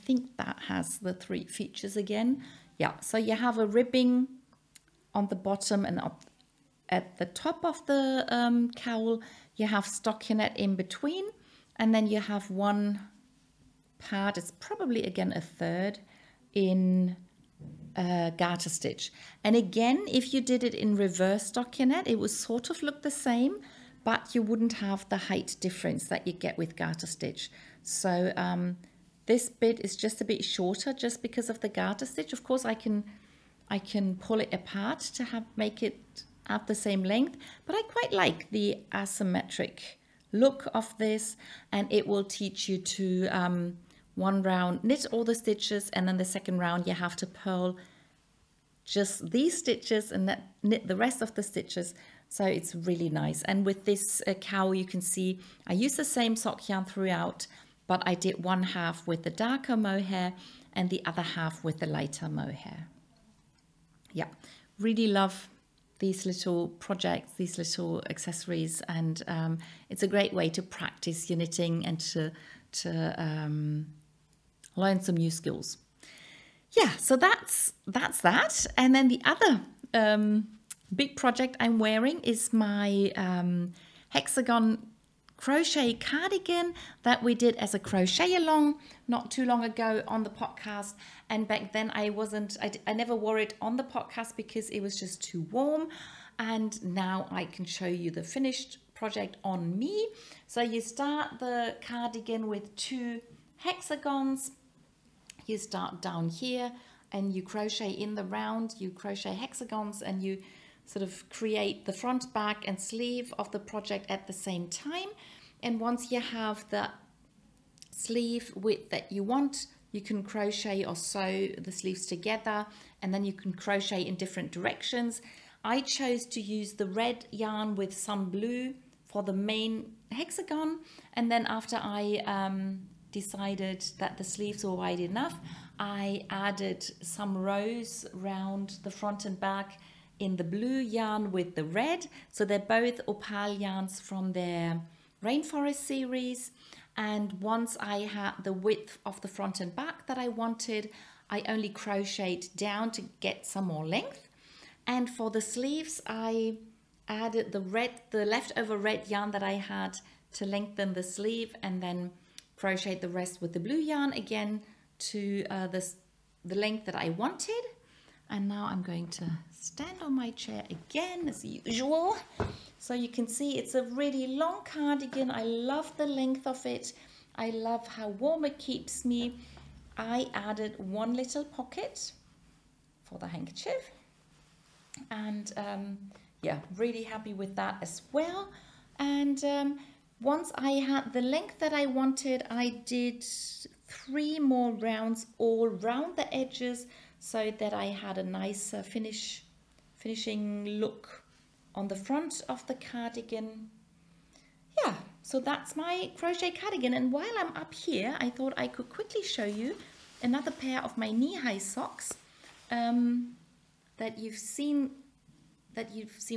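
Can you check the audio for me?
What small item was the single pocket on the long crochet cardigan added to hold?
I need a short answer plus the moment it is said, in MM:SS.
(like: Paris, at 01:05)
Handkerchief, at 03:03.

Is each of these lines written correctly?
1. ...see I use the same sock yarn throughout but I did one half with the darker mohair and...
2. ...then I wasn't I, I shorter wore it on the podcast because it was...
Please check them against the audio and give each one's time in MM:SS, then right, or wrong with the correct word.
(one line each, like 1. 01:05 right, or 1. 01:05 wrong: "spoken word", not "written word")
1. 00:55 right
2. 01:31 wrong: "never", not "shorter".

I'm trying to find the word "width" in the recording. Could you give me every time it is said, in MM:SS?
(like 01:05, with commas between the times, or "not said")
01:58, 02:28.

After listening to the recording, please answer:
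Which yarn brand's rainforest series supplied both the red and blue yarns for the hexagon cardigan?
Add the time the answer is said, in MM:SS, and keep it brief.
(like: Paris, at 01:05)
Opal, at 02:23.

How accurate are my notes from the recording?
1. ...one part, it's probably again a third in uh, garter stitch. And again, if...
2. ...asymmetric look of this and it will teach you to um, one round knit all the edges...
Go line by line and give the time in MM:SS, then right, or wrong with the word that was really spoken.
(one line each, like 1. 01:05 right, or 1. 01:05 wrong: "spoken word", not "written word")
1. 00:12 right
2. 00:38 wrong: "stitches", not "edges".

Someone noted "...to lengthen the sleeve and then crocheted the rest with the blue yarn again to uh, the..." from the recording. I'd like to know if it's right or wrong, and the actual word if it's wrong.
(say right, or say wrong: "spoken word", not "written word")
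right.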